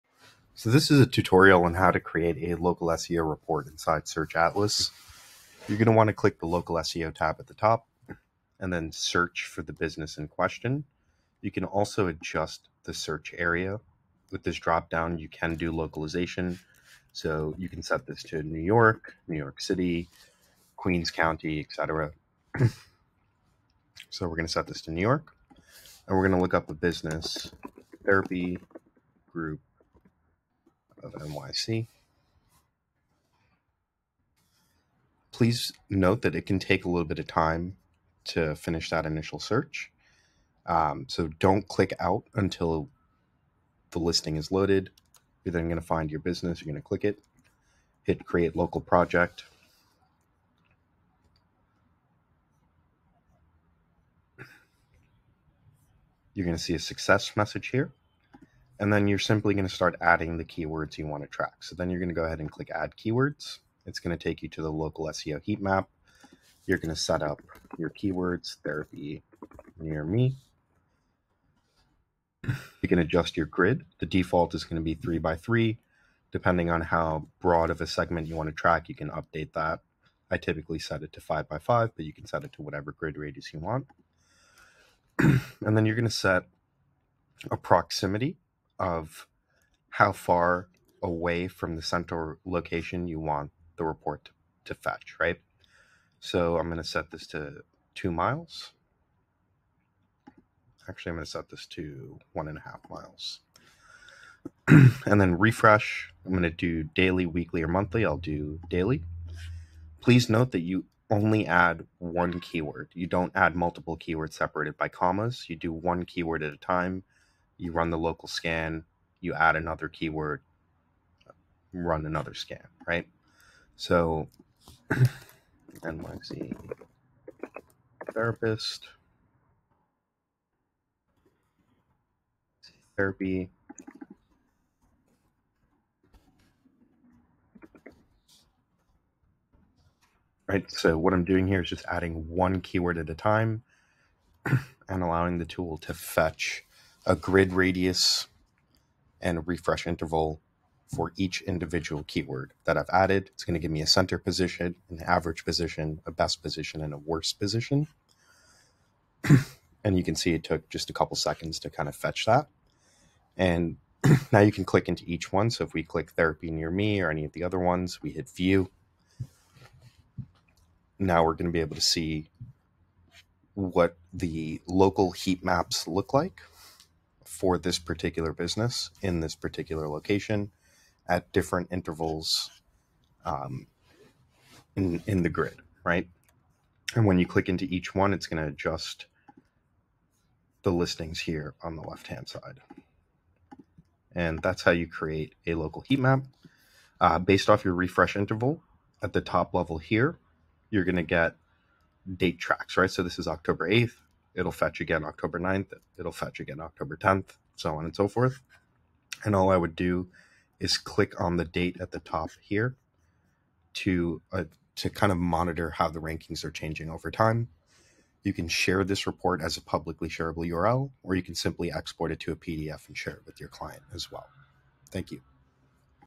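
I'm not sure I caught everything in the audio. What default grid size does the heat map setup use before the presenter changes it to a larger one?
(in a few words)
3 by 3.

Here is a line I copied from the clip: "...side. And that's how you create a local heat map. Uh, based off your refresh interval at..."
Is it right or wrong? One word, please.
right.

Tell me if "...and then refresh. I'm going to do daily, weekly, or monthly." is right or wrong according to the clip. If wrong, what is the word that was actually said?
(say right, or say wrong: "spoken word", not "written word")
right.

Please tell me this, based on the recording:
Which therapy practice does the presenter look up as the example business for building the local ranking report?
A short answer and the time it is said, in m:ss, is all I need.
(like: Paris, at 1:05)
Therapy Group of NYC, at 0:28.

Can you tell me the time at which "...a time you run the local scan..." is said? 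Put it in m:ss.
1:56.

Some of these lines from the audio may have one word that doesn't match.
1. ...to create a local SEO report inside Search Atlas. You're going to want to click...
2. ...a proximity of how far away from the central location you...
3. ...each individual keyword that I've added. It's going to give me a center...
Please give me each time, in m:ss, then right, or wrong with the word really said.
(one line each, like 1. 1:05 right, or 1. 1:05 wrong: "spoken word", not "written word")
1. 0:01 right
2. 1:27 right
3. 2:31 right.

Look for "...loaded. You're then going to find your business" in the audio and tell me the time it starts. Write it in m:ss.
0:44.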